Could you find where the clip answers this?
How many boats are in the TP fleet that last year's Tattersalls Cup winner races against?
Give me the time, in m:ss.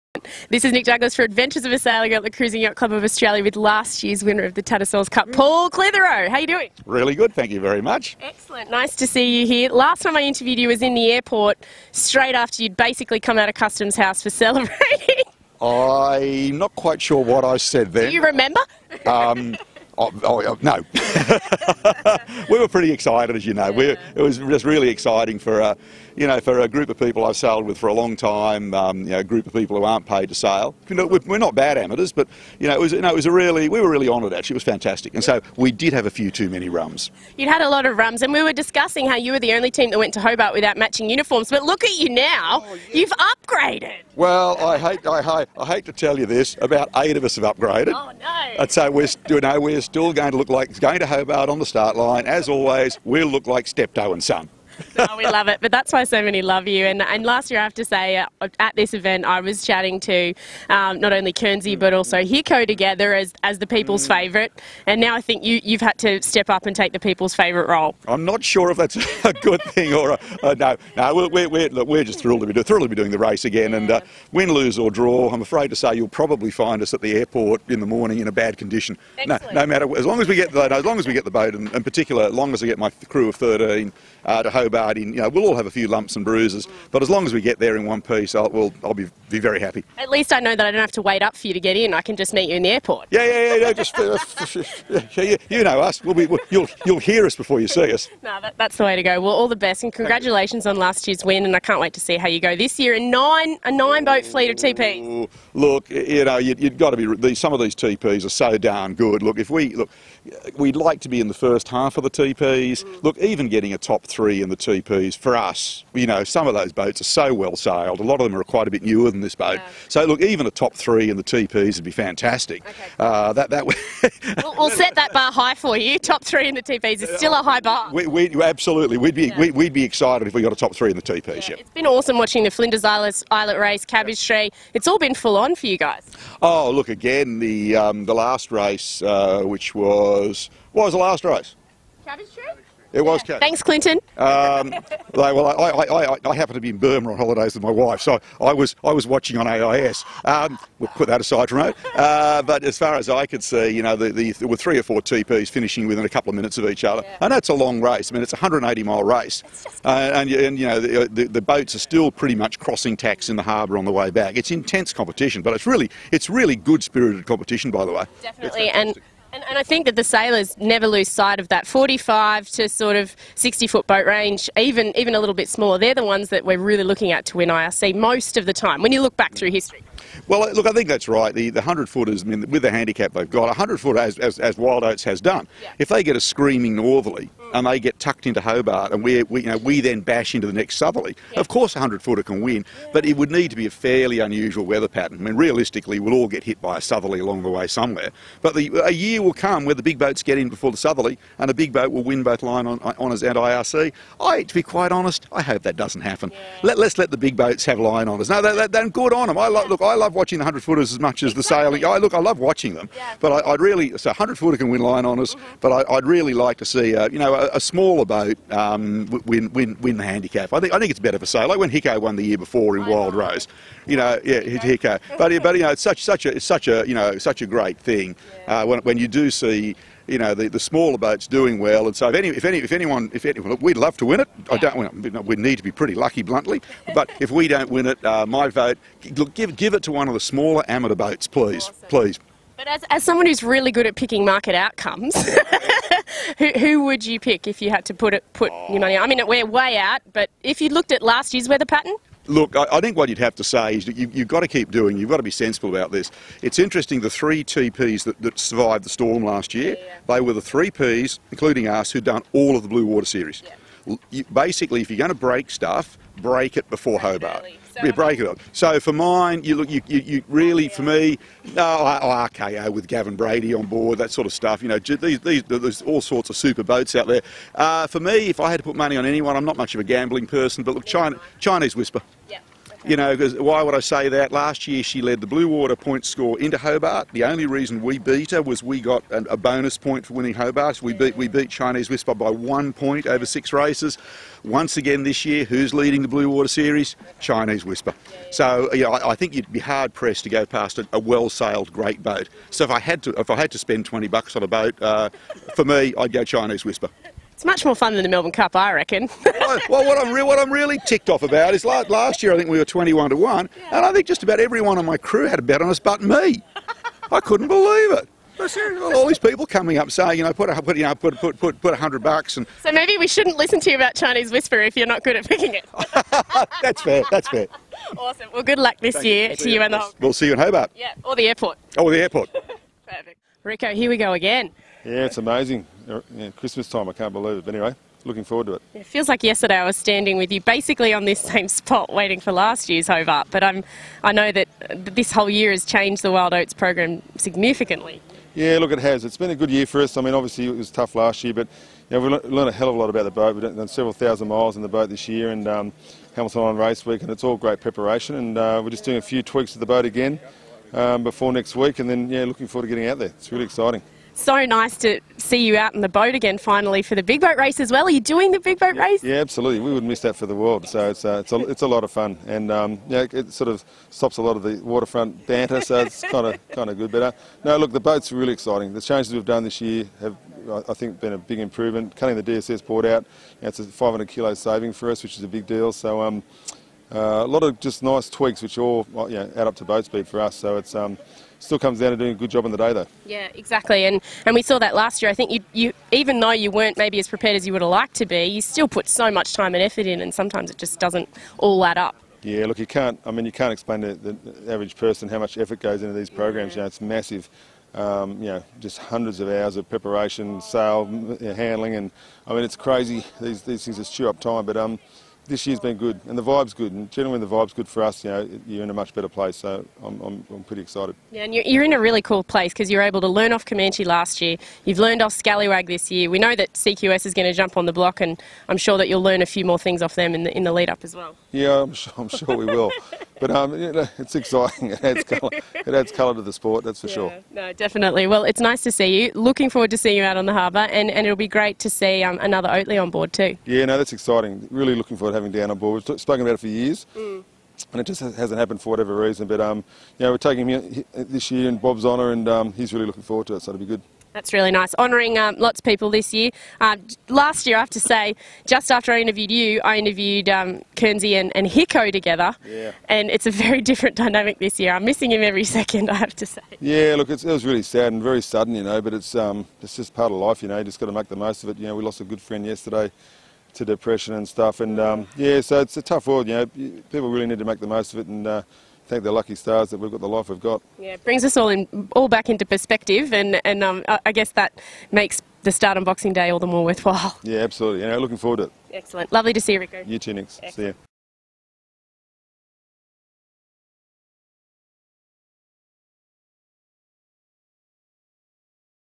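1:43.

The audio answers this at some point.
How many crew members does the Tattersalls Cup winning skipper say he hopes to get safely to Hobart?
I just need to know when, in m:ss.
1:23.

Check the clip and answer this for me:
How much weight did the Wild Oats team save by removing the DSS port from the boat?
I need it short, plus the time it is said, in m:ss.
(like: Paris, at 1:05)
500 kilos, at 6:23.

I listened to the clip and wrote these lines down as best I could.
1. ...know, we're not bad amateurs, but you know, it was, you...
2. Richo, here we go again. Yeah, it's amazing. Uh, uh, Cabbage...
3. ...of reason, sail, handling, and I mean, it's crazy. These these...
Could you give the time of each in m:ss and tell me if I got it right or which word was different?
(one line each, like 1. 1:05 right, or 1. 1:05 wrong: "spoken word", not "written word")
1. 0:30 right
2. 5:33 wrong: "Christmas", not "Cabbage"
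3. 6:49 wrong: "preparation", not "reason".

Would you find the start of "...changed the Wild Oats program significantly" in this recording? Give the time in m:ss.
5:45.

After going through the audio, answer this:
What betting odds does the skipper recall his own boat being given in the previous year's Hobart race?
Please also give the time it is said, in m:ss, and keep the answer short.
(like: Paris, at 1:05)
21 to 1, at 5:12.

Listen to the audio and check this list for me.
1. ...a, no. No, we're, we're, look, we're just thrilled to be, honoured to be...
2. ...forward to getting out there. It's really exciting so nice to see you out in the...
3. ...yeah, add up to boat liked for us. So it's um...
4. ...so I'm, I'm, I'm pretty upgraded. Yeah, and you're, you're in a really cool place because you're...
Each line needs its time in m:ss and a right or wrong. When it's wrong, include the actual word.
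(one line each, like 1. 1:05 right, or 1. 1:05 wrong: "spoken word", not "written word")
1. 1:10 wrong: "thrilled", not "honoured"
2. 6:02 right
3. 6:29 wrong: "speed", not "liked"
4. 6:59 wrong: "excited", not "upgraded".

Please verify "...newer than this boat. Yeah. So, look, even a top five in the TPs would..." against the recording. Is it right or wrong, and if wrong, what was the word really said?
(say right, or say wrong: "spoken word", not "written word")
wrong: "three", not "five".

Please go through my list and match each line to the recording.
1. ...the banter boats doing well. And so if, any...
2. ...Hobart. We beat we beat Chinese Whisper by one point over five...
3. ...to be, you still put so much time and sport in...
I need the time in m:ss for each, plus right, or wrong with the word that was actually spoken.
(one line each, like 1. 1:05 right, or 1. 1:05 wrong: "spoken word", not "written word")
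1. 3:50 wrong: "smaller", not "banter"
2. 4:50 wrong: "six", not "five"
3. 6:37 wrong: "effort", not "sport".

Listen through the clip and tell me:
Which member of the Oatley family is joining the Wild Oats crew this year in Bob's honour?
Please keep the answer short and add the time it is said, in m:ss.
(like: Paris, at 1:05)
Dan, at 7:25.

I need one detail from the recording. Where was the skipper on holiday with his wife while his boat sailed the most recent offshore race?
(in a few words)
Burma.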